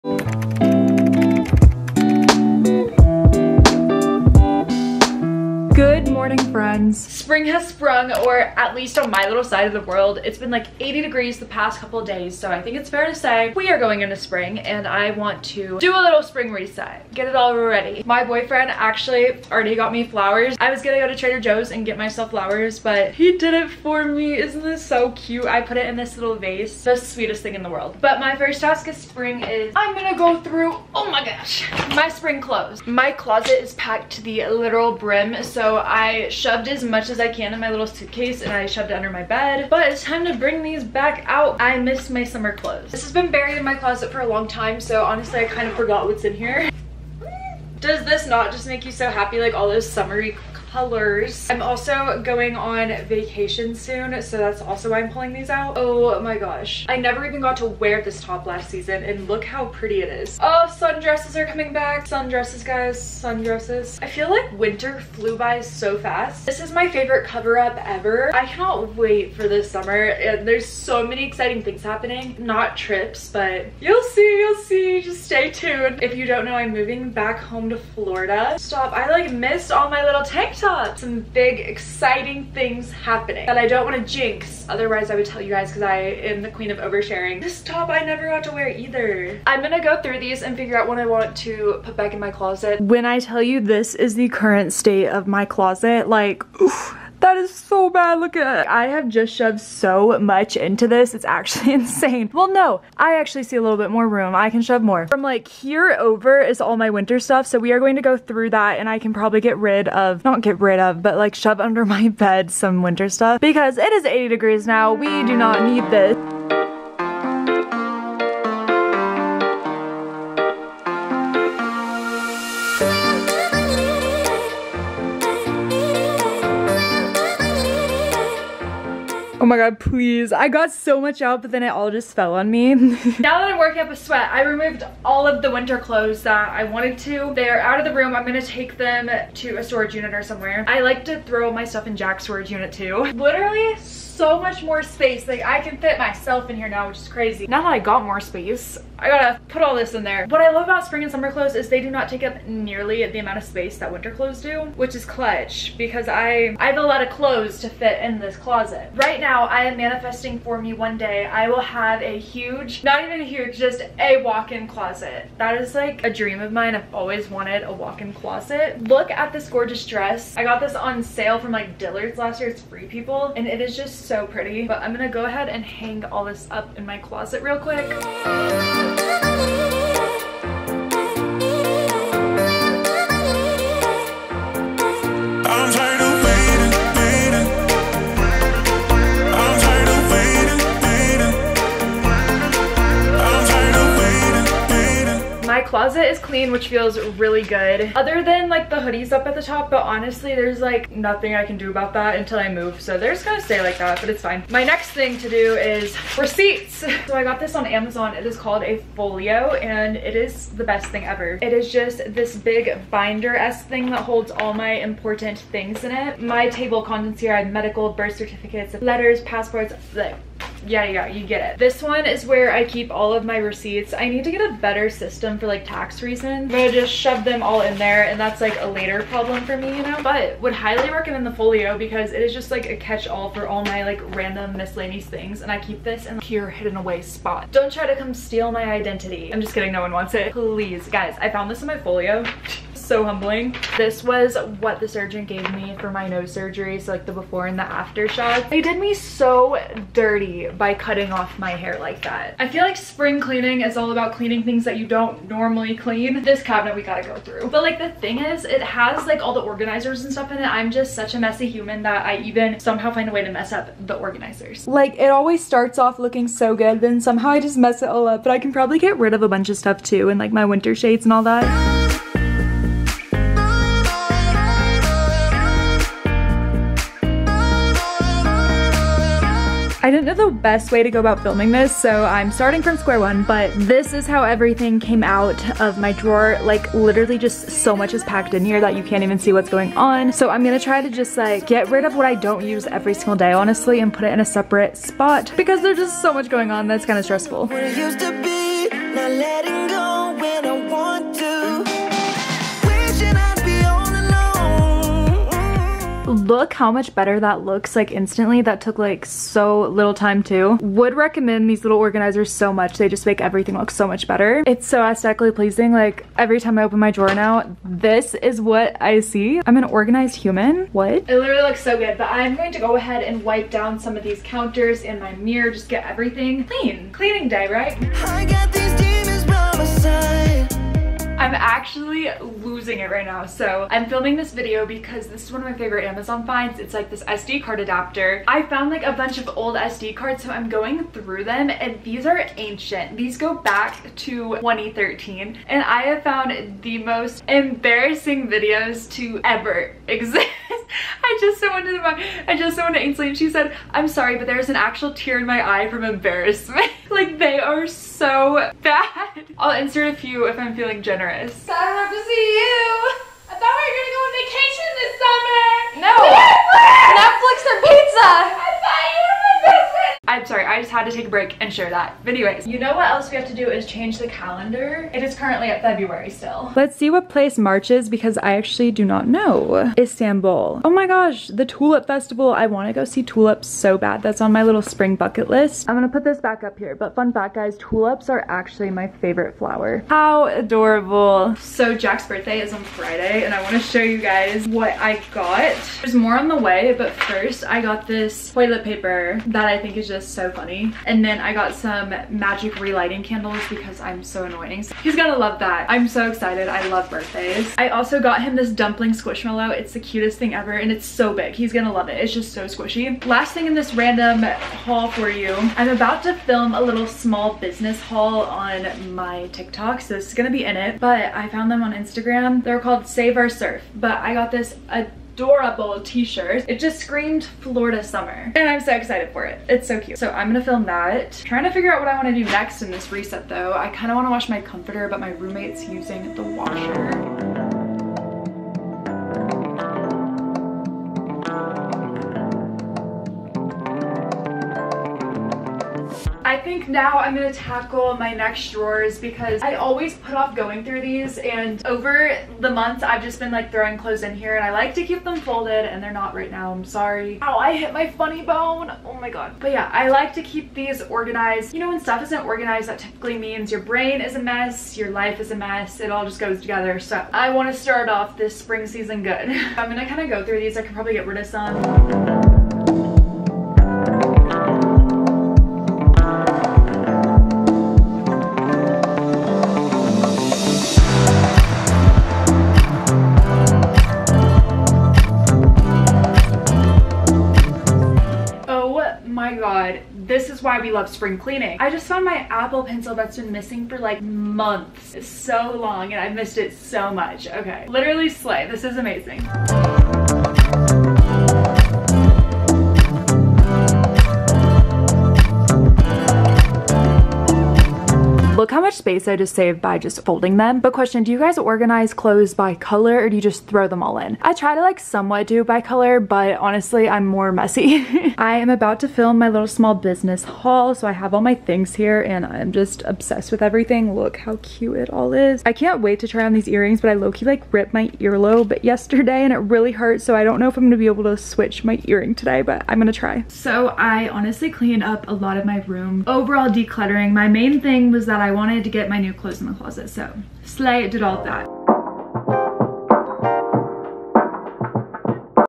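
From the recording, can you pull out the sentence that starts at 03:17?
Other than like the hoodies up at the top, but honestly, there's like nothing I can do about that until I move.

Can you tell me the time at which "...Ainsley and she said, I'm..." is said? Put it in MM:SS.
05:52.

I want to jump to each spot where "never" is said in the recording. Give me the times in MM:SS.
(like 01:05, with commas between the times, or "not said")
00:56, 01:28.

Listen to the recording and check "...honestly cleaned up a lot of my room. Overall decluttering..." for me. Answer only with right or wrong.
right.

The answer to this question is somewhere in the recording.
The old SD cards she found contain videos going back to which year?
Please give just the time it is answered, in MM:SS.
05:44.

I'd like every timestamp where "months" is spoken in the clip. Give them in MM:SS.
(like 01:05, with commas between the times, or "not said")
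07:32, 08:14.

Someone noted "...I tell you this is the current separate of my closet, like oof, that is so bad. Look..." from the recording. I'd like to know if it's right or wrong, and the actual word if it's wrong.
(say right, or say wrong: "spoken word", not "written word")
wrong: "state", not "separate".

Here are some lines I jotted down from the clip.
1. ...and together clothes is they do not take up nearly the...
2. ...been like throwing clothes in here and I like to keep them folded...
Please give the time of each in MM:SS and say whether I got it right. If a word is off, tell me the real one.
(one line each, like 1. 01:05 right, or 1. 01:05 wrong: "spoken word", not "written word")
1. 02:31 wrong: "summer", not "together"
2. 07:33 right.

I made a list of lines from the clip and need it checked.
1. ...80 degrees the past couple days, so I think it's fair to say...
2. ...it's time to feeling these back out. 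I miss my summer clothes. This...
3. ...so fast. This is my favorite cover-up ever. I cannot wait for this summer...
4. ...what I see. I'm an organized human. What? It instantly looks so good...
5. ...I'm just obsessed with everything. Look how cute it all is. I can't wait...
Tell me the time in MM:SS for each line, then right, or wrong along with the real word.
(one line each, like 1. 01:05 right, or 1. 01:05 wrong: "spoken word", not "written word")
1. 00:10 right
2. 00:39 wrong: "bring", not "feeling"
3. 01:05 right
4. 05:18 wrong: "literally", not "instantly"
5. 08:42 right.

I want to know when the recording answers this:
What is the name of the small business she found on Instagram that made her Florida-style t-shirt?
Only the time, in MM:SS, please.
07:02.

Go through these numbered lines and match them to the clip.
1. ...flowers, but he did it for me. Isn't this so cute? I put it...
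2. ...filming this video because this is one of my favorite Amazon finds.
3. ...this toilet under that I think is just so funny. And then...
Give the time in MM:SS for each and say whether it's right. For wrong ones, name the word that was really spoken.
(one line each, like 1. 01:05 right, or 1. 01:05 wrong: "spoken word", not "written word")
1. 00:22 right
2. 05:33 right
3. 06:37 wrong: "paper", not "under".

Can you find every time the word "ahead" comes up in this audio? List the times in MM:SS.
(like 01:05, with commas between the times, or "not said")
02:55, 05:22.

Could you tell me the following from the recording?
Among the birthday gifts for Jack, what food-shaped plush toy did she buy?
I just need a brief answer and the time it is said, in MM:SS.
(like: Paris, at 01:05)
dumpling squishmallow, at 06:48.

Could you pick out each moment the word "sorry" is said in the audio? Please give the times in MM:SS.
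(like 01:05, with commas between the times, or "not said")
05:53, 06:10, 07:36.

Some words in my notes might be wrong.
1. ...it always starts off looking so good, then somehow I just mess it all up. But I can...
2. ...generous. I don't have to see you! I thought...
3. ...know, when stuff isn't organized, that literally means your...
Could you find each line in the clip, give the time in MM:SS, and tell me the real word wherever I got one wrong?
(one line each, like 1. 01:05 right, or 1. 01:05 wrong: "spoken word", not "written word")
1. 04:24 right
2. 06:00 right
3. 07:41 wrong: "typically", not "literally".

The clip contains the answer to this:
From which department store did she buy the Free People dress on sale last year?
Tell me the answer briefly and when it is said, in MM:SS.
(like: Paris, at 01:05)
Dillard's, at 02:51.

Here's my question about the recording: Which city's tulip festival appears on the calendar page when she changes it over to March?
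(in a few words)
Istanbul.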